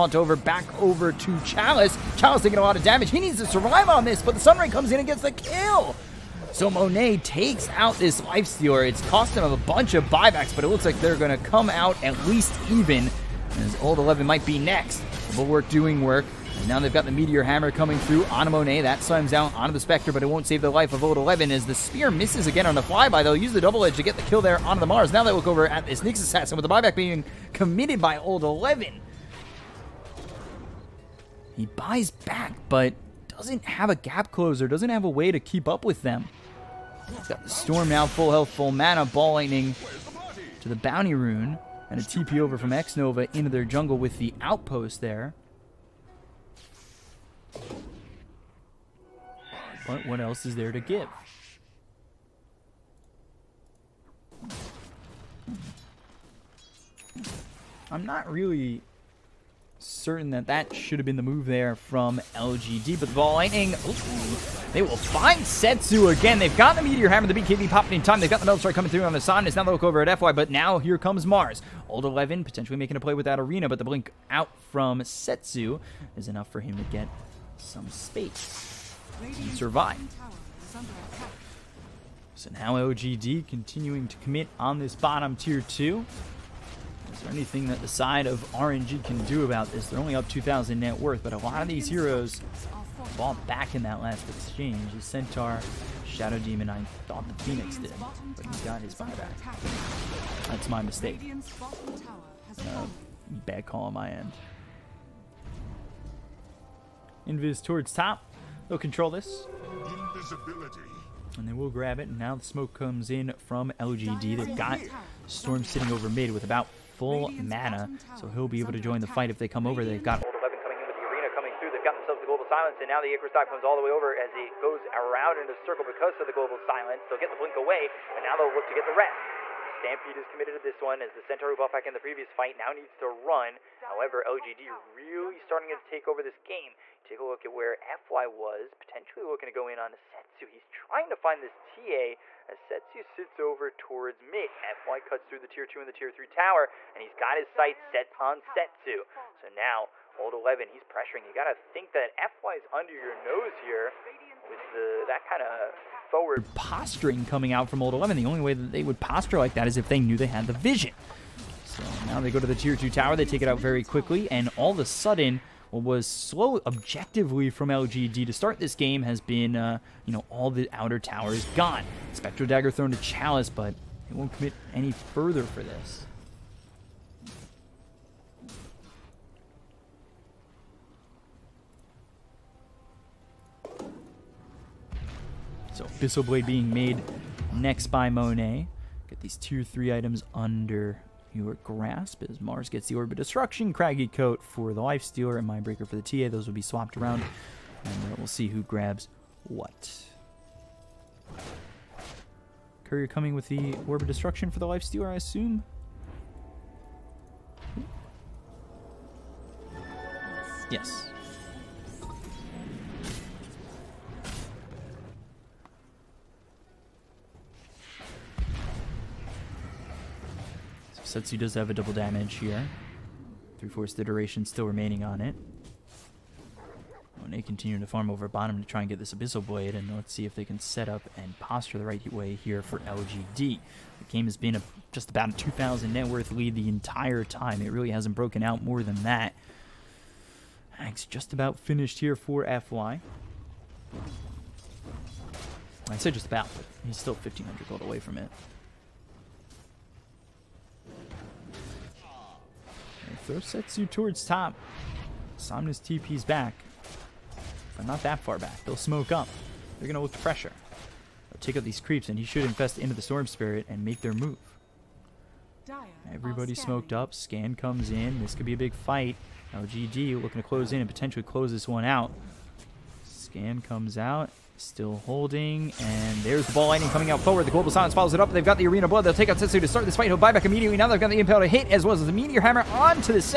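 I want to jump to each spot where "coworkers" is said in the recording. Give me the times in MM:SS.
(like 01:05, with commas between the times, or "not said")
not said.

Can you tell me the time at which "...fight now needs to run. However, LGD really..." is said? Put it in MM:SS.
02:12.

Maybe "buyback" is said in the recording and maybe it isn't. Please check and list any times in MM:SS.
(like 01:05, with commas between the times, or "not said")
00:10, 00:26, 01:38.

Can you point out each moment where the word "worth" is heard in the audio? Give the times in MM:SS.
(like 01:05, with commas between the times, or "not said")
01:30, 03:56.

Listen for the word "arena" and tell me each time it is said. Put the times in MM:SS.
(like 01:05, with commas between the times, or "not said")
01:13, 02:01, 04:38.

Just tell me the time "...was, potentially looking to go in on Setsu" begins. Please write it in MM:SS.
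02:18.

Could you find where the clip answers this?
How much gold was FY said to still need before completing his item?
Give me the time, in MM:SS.
04:07.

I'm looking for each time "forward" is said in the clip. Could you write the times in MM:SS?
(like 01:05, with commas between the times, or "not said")
02:36, 04:37.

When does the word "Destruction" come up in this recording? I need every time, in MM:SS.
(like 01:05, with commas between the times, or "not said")
03:13, 03:24.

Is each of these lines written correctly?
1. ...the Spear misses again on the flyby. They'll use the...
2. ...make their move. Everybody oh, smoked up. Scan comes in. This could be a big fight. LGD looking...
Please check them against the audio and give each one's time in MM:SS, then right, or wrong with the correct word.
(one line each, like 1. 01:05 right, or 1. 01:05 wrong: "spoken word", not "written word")
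1. 00:21 right
2. 04:23 right.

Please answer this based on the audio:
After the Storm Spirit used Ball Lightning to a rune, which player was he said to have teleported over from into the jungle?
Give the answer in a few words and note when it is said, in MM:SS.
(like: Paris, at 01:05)
X Nova, at 00:42.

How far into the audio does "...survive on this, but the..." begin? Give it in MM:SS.
00:03.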